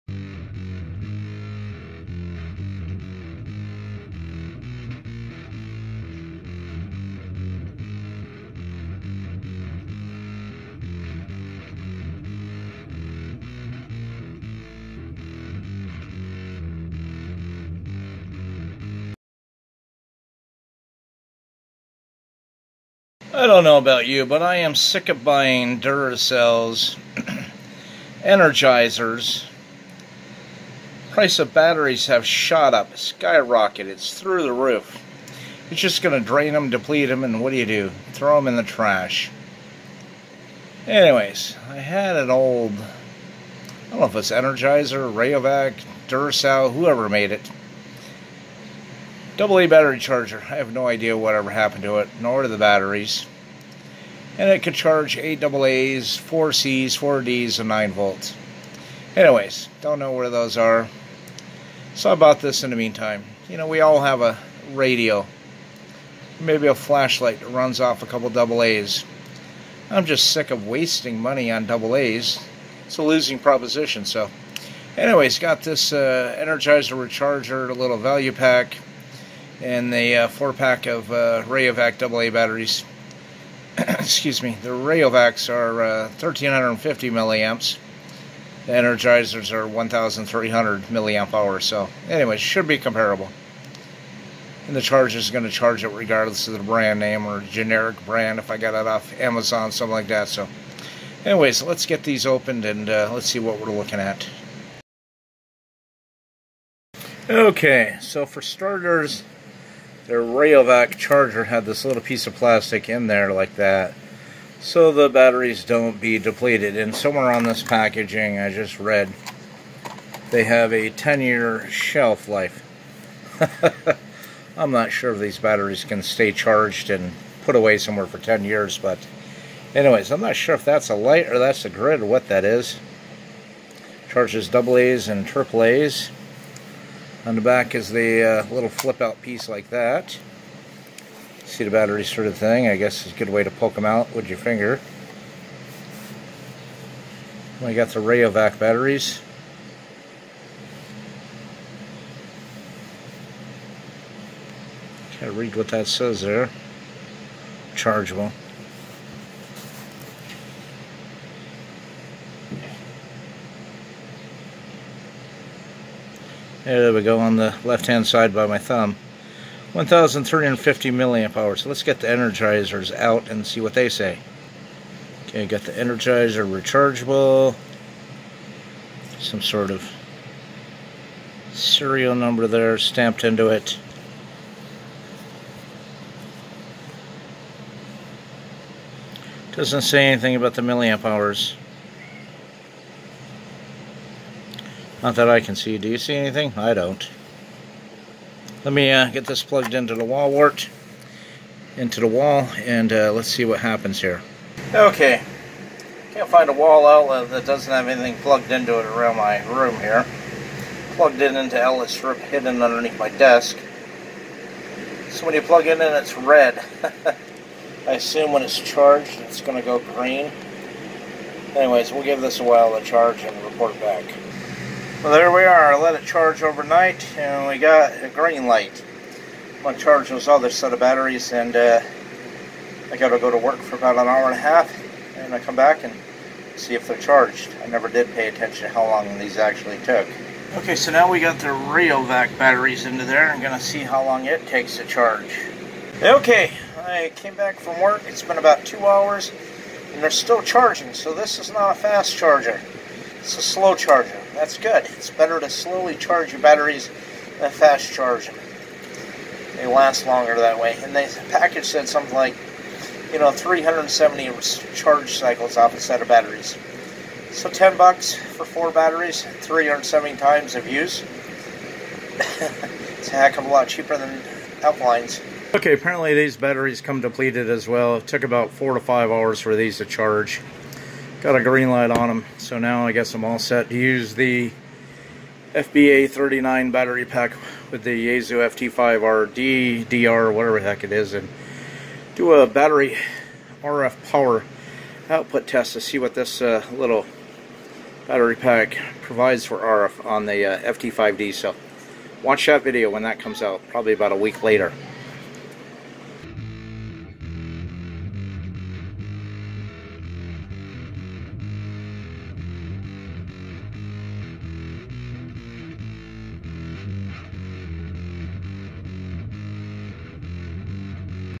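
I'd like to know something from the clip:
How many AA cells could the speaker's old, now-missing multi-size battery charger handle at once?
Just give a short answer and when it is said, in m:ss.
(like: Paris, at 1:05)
8, at 0:55.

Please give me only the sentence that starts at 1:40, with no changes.
So, anyways, let's get these opened and uh, let's see what we're looking at.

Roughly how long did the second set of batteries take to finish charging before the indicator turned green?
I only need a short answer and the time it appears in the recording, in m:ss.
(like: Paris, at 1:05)
4 to 5 hours, at 4:38.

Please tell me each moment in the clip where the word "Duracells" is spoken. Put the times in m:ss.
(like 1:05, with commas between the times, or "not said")
0:25, 0:46.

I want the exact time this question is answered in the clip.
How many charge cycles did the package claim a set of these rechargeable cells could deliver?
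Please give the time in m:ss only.
4:23.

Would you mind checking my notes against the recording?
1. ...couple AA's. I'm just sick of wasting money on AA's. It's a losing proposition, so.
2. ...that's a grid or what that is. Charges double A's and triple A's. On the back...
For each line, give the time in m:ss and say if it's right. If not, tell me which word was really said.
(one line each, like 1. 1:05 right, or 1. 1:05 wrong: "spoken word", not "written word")
1. 1:08 right
2. 2:11 right.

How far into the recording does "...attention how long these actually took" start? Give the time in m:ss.
3:58.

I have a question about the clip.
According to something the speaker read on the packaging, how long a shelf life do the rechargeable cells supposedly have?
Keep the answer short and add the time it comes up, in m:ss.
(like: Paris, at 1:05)
10 years, at 2:00.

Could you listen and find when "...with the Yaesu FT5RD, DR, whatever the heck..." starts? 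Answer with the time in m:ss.
4:47.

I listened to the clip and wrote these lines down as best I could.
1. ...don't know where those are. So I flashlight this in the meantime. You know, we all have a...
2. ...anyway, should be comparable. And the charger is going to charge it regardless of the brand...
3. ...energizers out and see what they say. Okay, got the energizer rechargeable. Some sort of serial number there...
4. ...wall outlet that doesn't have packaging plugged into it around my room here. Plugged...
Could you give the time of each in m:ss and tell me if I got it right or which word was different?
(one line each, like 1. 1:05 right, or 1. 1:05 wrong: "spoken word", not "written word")
1. 0:59 wrong: "bought", not "flashlight"
2. 1:32 right
3. 2:52 right
4. 3:26 wrong: "anything", not "packaging".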